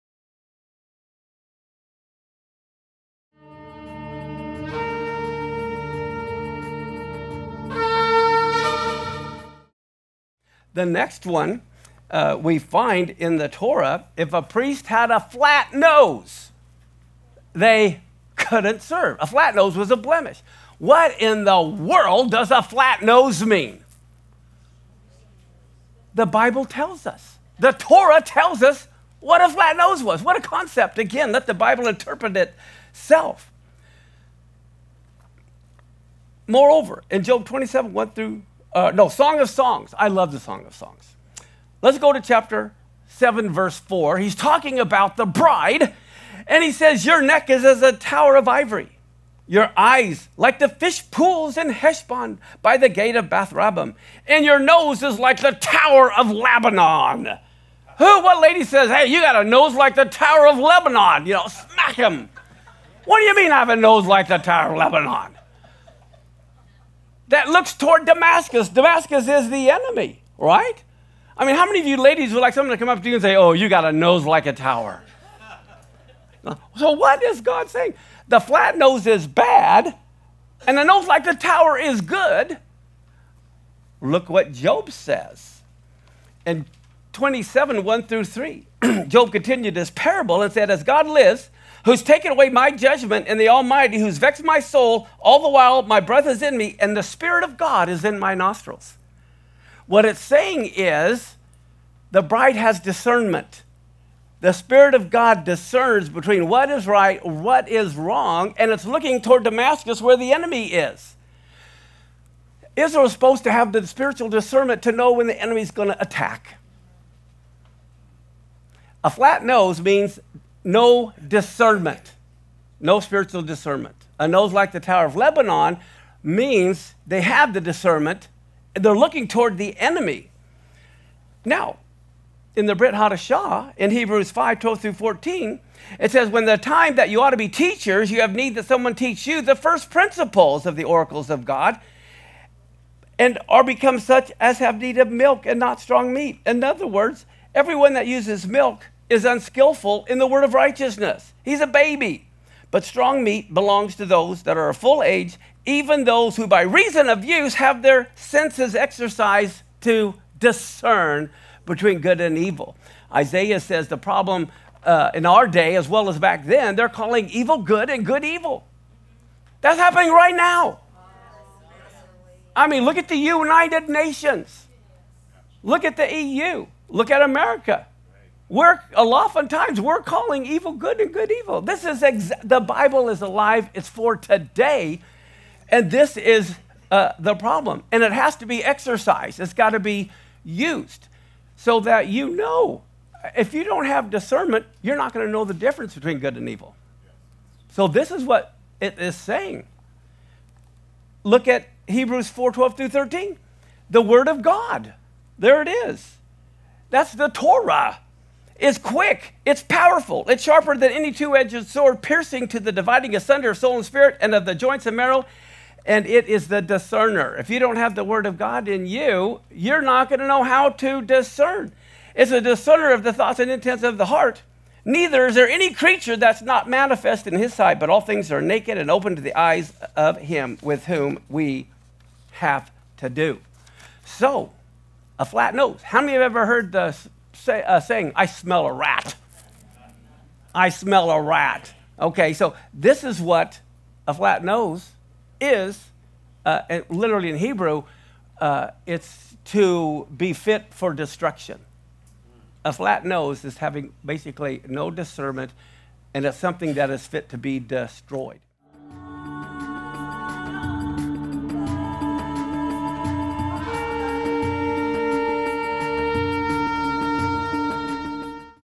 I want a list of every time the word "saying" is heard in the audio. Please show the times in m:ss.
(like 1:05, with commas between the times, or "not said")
1:17, 1:40, 3:19, 3:57.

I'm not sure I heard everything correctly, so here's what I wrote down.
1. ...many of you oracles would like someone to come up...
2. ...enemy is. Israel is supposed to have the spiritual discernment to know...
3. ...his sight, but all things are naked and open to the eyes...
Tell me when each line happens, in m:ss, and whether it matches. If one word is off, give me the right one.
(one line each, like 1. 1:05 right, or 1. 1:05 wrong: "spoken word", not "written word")
1. 1:11 wrong: "ladies", not "oracles"
2. 1:50 right
3. 3:47 right.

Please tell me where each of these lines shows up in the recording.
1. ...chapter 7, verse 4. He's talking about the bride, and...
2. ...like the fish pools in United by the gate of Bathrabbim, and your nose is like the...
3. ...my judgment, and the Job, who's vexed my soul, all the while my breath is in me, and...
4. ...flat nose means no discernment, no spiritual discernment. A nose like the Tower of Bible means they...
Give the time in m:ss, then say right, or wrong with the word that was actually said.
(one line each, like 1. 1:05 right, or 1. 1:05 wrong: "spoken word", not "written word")
1. 0:42 right
2. 0:50 wrong: "Heshbon", not "United"
3. 1:32 wrong: "Almighty", not "Job"
4. 1:59 wrong: "Lebanon", not "Bible".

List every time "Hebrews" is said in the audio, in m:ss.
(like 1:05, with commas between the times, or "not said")
2:13, 3:21, 4:07.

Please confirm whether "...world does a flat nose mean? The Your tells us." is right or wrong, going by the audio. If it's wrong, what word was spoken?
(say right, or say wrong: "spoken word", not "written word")
wrong: "Bible", not "Your".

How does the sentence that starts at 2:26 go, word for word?
In other words, everyone that uses milk is unskillful in the word of righteousness.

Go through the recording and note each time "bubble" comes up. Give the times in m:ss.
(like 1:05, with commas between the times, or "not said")
not said.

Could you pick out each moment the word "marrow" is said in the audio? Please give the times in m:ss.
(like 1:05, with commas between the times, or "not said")
3:34.